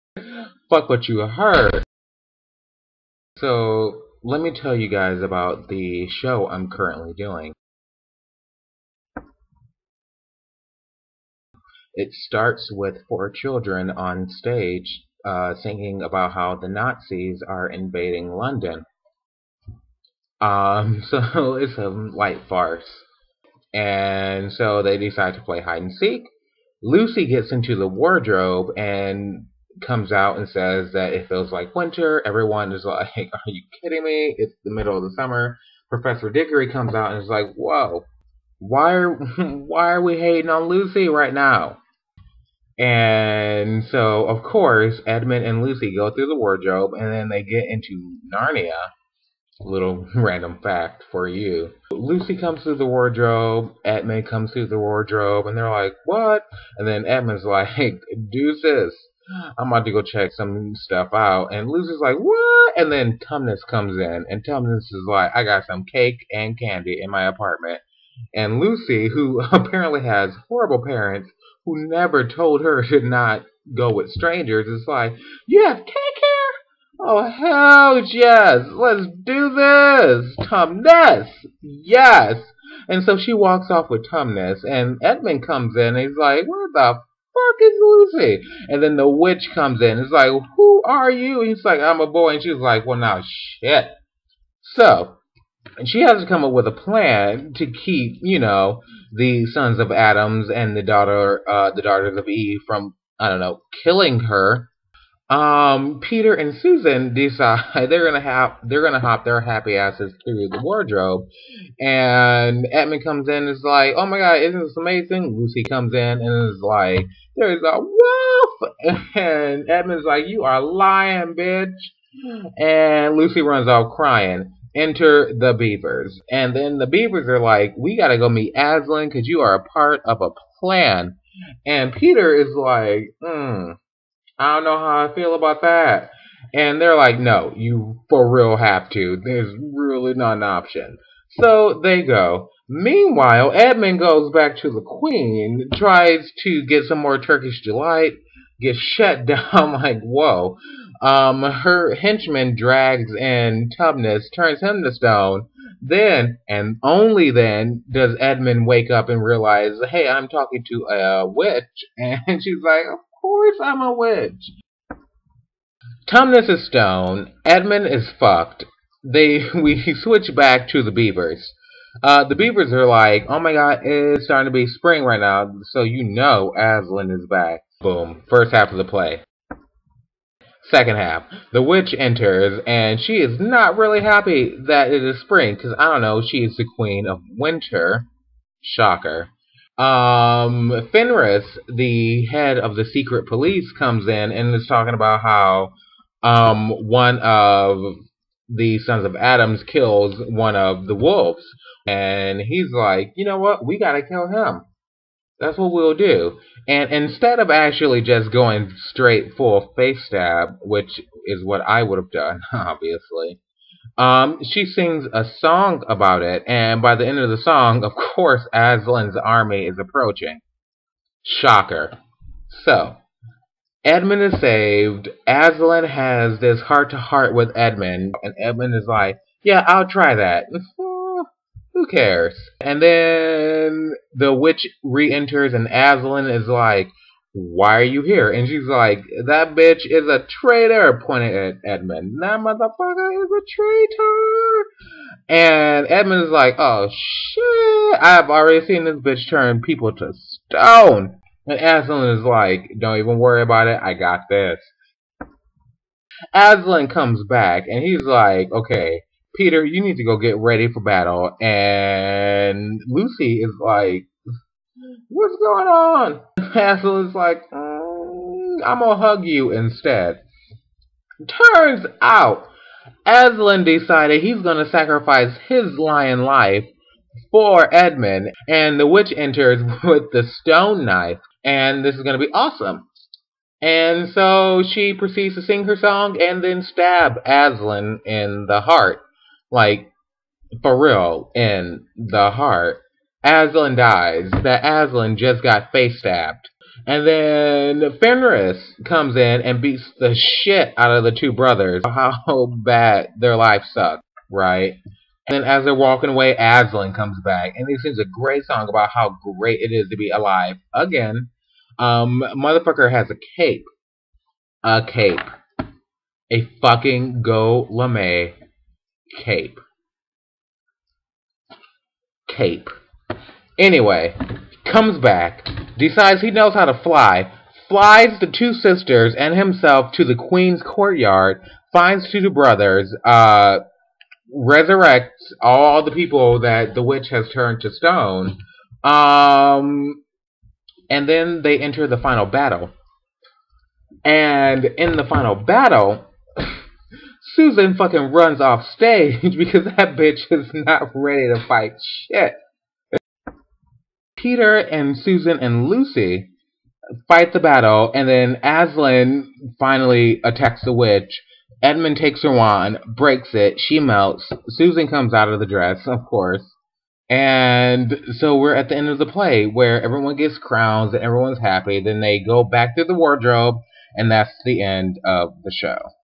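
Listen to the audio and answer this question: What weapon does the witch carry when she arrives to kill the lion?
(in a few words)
The stone knife.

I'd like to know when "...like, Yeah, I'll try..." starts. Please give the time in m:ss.
3:48.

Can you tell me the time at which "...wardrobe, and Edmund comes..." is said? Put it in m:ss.
1:50.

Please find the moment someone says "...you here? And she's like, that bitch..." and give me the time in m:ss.
3:57.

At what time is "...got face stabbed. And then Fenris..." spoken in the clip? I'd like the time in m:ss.
4:55.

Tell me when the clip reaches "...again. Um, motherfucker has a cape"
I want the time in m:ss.
5:10.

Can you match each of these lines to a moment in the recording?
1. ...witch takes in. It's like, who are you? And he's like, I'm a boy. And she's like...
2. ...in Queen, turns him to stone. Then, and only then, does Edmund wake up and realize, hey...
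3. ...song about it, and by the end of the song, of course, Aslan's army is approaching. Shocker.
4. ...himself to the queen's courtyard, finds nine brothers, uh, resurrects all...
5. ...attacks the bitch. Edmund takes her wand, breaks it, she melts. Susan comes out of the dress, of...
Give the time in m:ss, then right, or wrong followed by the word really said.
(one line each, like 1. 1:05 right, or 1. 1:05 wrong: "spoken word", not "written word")
1. 1:29 wrong: "comes", not "takes"
2. 2:33 wrong: "Tumnus", not "Queen"
3. 3:35 right
4. 5:29 wrong: "two", not "nine"
5. 6:00 wrong: "witch", not "bitch".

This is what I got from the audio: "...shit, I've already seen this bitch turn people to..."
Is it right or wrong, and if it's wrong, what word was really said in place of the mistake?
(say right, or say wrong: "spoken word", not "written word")
right.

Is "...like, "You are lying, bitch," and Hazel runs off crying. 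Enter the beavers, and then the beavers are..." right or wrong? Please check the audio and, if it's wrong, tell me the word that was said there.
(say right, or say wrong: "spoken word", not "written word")
wrong: "Lucy", not "Hazel".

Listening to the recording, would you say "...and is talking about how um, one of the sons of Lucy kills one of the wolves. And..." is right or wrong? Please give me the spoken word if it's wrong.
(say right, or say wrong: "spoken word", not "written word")
wrong: "Adams", not "Lucy".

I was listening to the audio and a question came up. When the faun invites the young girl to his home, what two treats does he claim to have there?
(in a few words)
Cake and candy.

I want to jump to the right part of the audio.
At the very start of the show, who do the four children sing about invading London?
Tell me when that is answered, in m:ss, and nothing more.
0:16.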